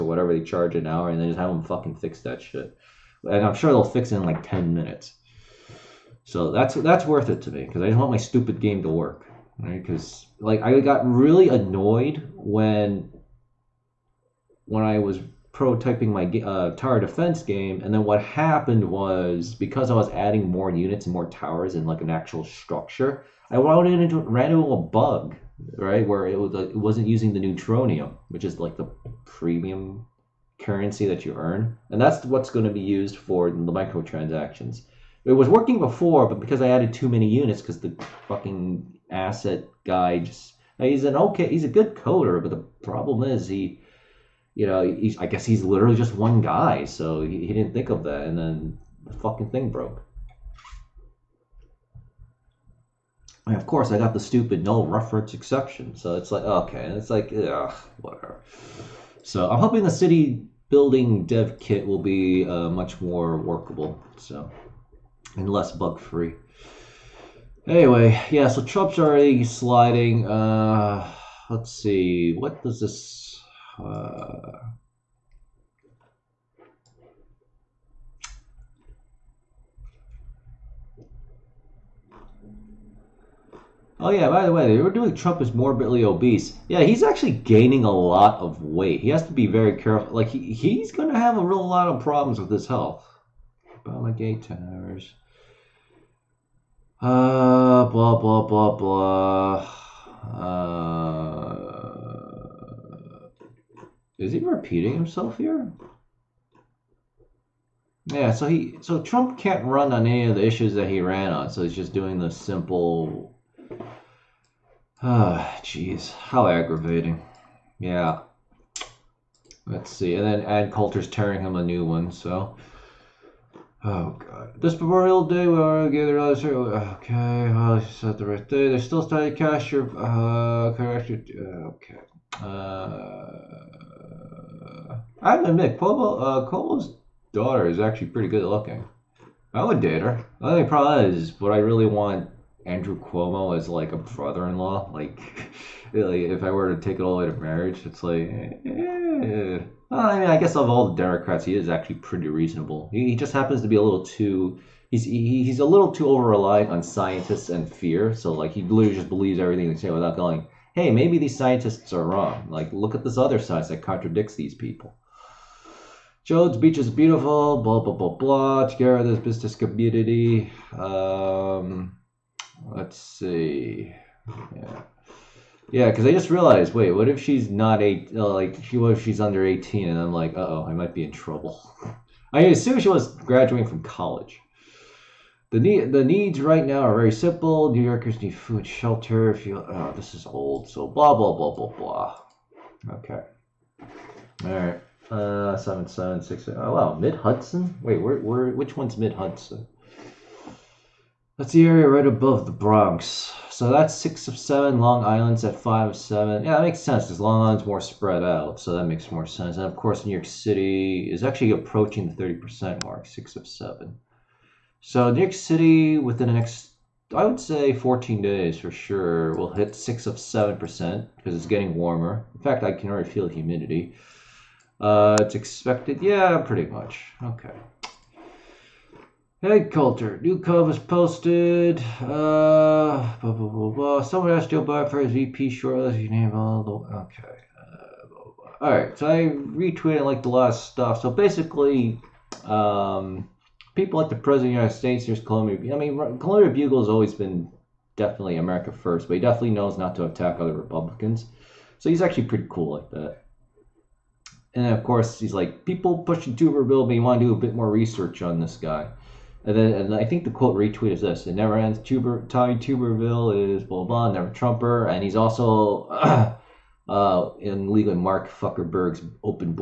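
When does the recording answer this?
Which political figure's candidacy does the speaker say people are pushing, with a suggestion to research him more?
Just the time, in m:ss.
4:22.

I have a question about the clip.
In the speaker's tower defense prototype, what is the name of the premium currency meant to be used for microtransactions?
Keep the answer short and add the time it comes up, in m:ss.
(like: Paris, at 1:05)
neutronium, at 0:27.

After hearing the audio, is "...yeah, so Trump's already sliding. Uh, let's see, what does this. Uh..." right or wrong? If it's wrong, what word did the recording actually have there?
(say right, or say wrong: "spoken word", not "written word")
right.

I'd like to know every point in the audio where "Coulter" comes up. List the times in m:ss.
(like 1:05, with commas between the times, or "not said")
2:00, 3:49.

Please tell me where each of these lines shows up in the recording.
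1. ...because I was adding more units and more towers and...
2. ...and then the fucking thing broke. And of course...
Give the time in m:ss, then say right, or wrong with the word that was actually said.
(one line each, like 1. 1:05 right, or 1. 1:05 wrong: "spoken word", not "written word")
1. 0:19 right
2. 0:48 right.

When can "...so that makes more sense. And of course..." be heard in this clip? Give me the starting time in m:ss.
3:28.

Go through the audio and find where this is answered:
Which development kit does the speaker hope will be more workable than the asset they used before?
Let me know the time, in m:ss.
0:59.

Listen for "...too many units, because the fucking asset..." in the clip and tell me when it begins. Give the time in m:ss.
0:36.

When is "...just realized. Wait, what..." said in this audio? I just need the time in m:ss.
2:56.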